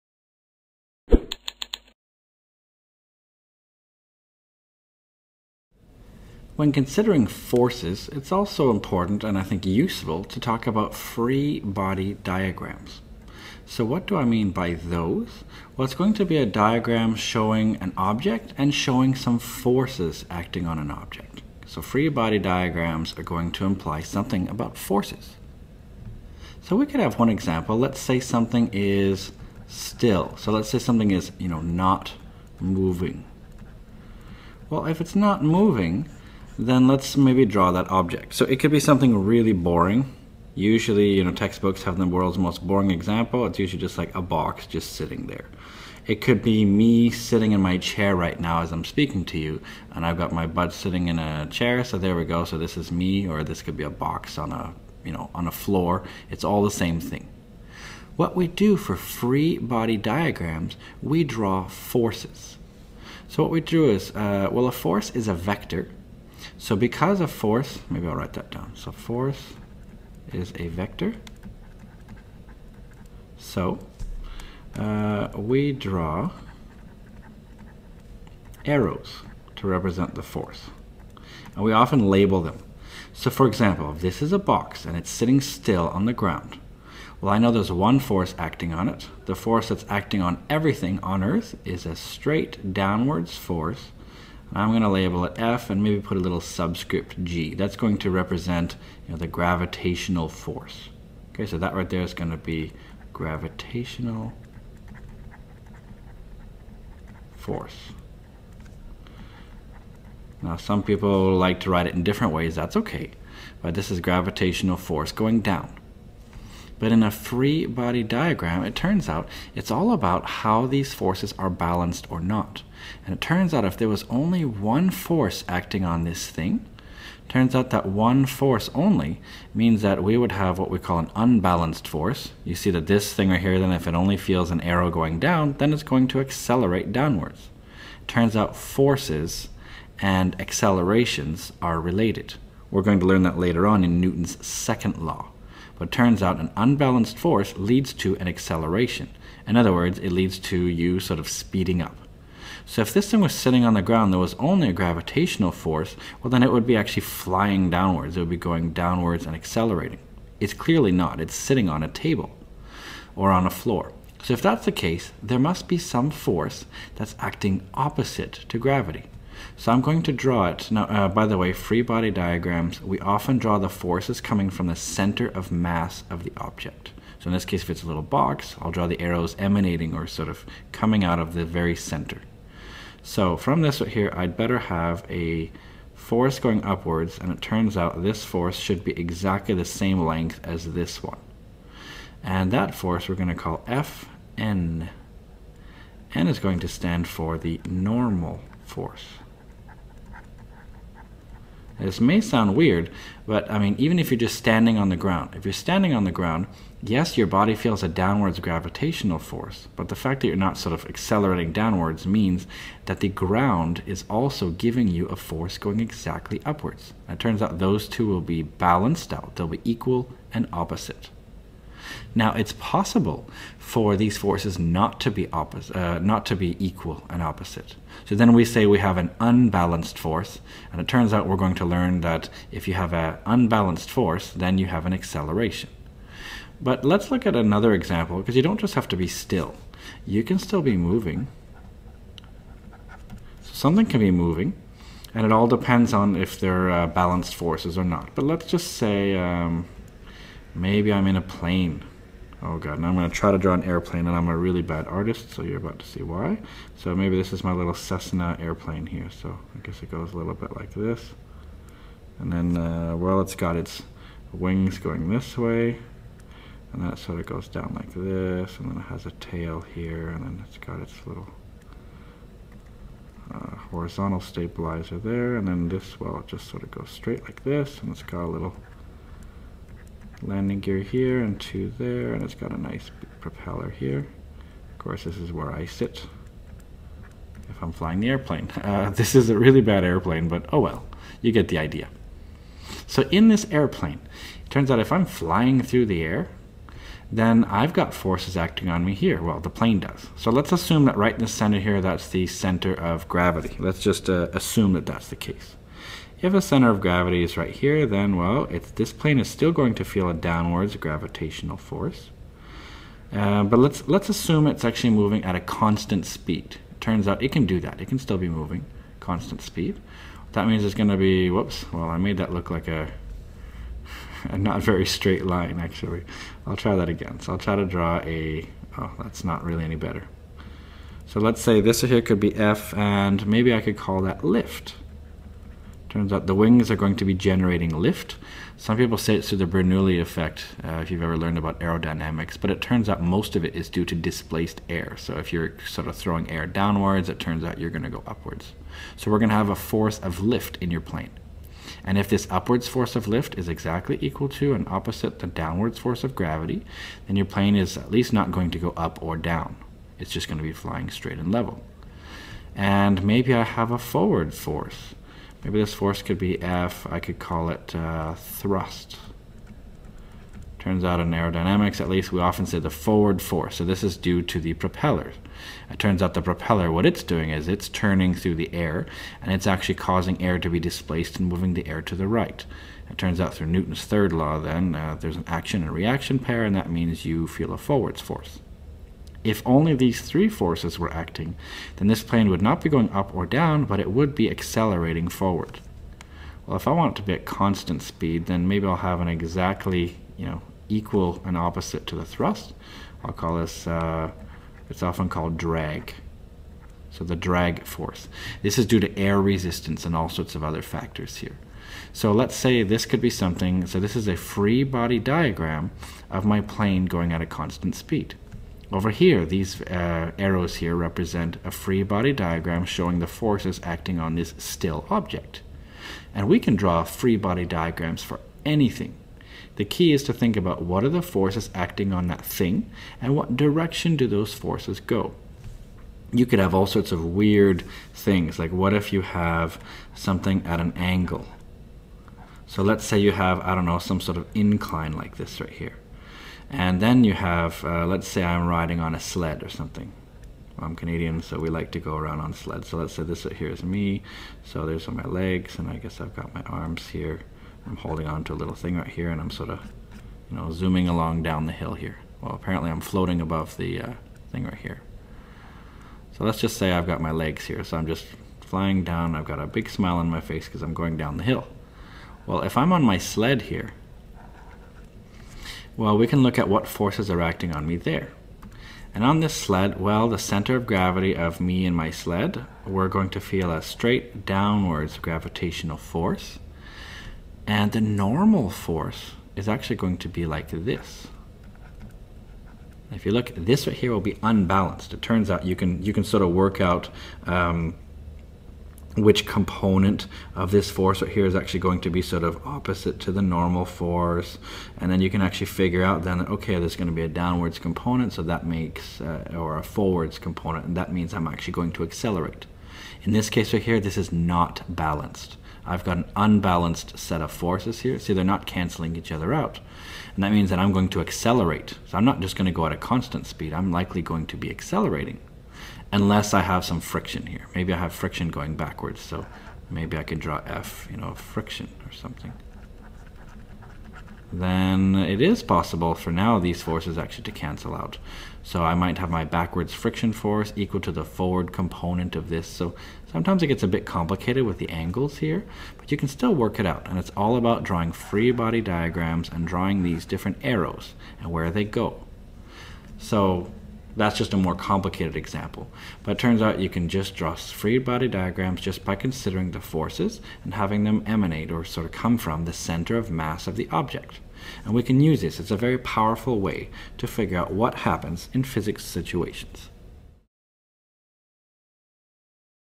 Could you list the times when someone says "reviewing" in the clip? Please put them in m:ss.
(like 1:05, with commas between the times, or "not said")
not said.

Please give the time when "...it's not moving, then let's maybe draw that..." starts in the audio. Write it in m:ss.
0:35.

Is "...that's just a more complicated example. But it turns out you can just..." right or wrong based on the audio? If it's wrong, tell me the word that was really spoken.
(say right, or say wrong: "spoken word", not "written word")
right.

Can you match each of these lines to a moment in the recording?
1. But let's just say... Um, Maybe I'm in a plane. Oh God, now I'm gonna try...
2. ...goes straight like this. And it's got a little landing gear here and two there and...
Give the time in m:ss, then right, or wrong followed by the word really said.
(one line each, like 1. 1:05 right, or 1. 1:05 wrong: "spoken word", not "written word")
1. 4:08 right
2. 4:36 right.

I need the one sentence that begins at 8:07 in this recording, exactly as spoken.
And the normal force is actually going to be like this.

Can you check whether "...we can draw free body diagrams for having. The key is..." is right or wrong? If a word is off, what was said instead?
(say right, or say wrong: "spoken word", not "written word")
wrong: "anything", not "having".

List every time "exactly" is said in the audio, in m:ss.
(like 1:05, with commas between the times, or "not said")
3:08, 3:35, 5:53, 6:39.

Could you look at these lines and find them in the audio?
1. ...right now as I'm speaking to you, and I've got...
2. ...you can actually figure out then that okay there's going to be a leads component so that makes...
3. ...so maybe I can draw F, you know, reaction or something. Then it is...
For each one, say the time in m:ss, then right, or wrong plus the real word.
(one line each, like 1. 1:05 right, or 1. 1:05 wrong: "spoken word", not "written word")
1. 0:48 right
2. 8:25 wrong: "downwards", not "leads"
3. 8:49 wrong: "friction", not "reaction".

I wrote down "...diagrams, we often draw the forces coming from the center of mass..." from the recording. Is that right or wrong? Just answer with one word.
right.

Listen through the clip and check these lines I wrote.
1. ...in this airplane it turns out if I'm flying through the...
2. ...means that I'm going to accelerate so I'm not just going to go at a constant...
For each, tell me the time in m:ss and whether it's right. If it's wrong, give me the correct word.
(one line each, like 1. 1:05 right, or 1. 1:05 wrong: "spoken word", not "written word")
1. 4:53 right
2. 8:40 right.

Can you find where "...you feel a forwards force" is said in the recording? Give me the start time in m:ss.
6:27.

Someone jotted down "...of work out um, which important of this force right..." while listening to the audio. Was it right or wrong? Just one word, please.
wrong.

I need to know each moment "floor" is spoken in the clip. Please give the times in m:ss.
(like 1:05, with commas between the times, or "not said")
0:55, 2:43.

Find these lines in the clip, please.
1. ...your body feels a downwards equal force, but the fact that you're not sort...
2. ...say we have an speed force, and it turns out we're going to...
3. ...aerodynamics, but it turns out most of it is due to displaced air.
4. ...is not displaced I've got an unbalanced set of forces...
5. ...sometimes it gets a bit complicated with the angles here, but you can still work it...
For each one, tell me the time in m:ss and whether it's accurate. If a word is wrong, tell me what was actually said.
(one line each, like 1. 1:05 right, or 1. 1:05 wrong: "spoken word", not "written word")
1. 3:27 wrong: "gravitational", not "equal"
2. 3:48 wrong: "unbalanced", not "speed"
3. 5:41 right
4. 8:33 wrong: "balanced", not "displaced"
5. 9:03 right.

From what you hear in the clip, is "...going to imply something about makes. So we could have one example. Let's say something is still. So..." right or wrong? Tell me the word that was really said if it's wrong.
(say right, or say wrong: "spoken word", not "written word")
wrong: "forces", not "makes".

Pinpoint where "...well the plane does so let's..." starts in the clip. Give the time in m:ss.
4:59.